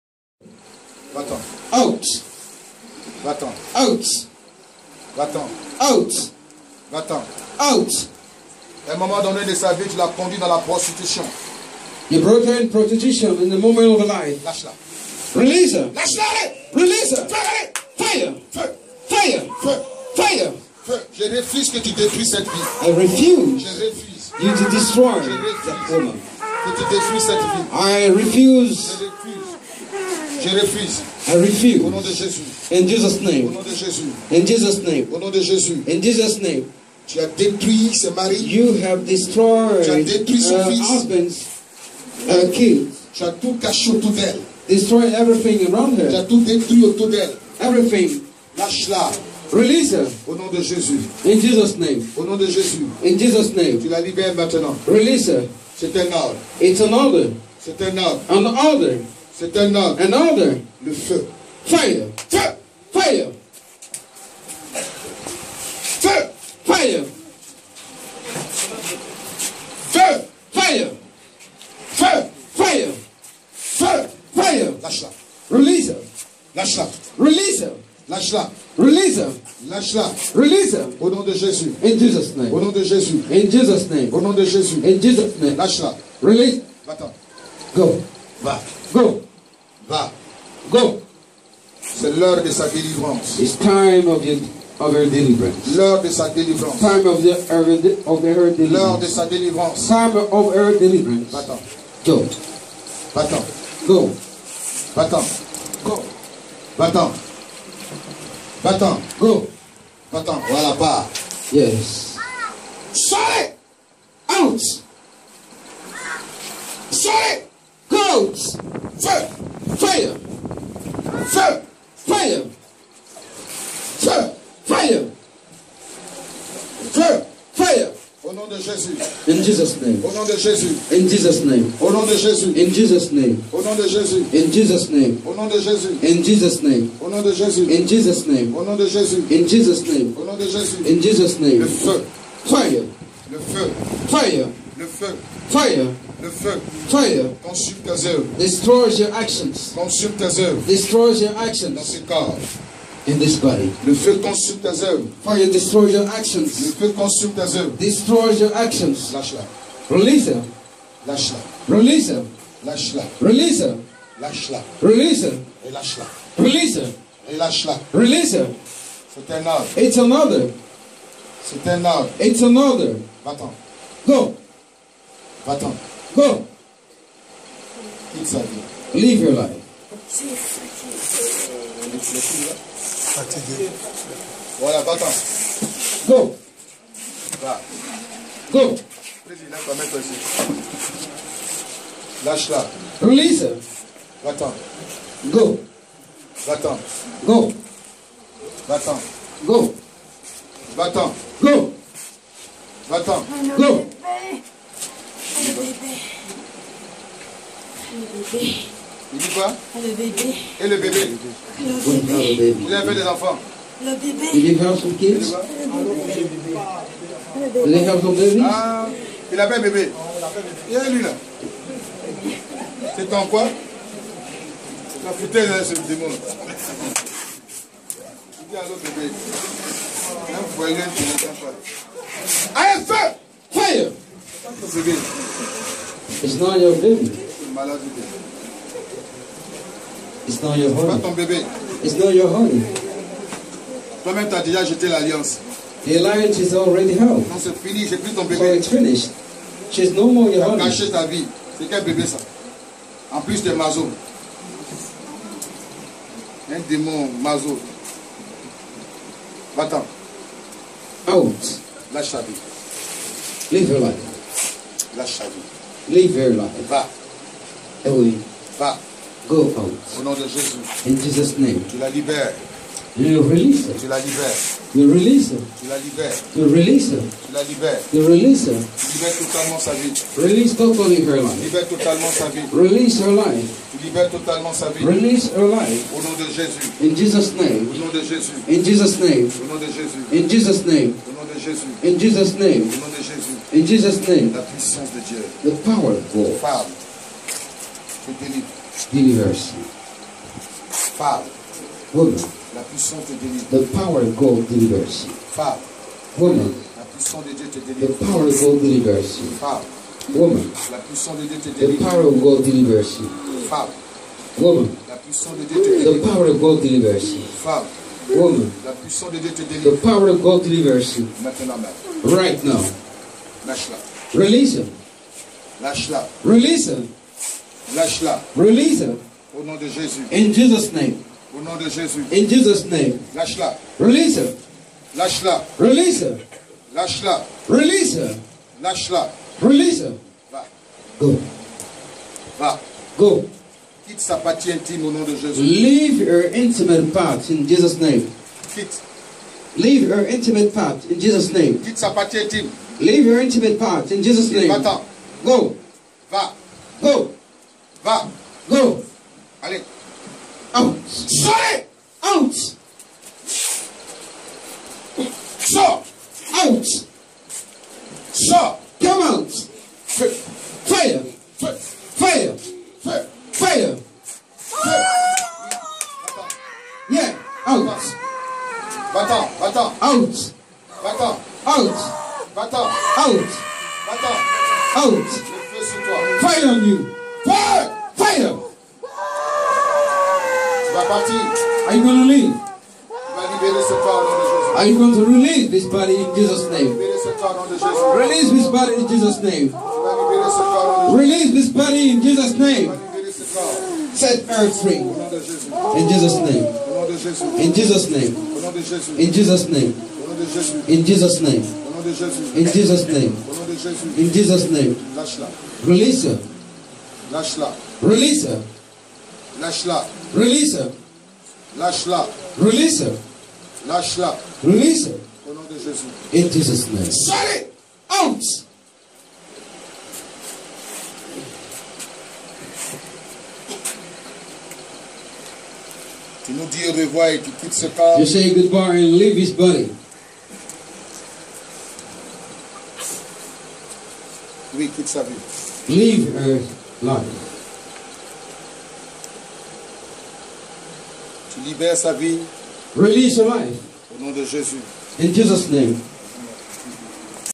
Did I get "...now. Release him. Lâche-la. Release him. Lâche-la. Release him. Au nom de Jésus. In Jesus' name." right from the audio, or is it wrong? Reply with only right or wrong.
right.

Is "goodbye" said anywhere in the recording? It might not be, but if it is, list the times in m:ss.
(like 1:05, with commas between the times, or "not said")
7:18.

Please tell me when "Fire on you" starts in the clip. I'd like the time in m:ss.
6:26.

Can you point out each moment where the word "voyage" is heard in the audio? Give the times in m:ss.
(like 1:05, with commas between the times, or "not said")
3:50.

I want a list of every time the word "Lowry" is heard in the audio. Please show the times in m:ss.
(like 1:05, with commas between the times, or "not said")
not said.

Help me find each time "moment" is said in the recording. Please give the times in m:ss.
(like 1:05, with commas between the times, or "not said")
0:08, 0:13.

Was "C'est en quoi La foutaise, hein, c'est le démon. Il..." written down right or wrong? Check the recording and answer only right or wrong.
right.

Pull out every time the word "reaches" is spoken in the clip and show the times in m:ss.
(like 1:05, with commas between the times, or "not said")
not said.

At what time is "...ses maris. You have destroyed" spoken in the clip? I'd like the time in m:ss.
0:37.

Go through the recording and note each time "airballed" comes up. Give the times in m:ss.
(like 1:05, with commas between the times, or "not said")
not said.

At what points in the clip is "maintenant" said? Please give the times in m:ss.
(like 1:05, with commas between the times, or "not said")
0:54, 5:21.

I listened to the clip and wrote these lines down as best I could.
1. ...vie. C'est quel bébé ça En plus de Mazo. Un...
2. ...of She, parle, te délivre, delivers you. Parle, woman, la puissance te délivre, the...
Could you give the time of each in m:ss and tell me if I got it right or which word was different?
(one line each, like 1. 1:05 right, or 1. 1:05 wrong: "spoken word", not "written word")
1. 4:11 right
2. 4:55 wrong: "God", not "She".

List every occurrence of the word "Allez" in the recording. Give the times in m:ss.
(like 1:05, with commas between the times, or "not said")
3:52, 5:59.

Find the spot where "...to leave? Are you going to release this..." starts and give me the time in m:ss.
6:31.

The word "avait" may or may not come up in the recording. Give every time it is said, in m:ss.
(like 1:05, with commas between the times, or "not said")
3:32, 3:39.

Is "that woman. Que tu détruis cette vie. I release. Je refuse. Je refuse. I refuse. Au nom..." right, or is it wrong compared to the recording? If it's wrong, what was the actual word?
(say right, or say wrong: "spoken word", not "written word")
wrong: "refuse", not "release".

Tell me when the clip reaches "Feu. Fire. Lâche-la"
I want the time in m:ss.
1:13.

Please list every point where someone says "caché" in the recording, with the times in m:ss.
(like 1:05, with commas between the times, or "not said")
0:43.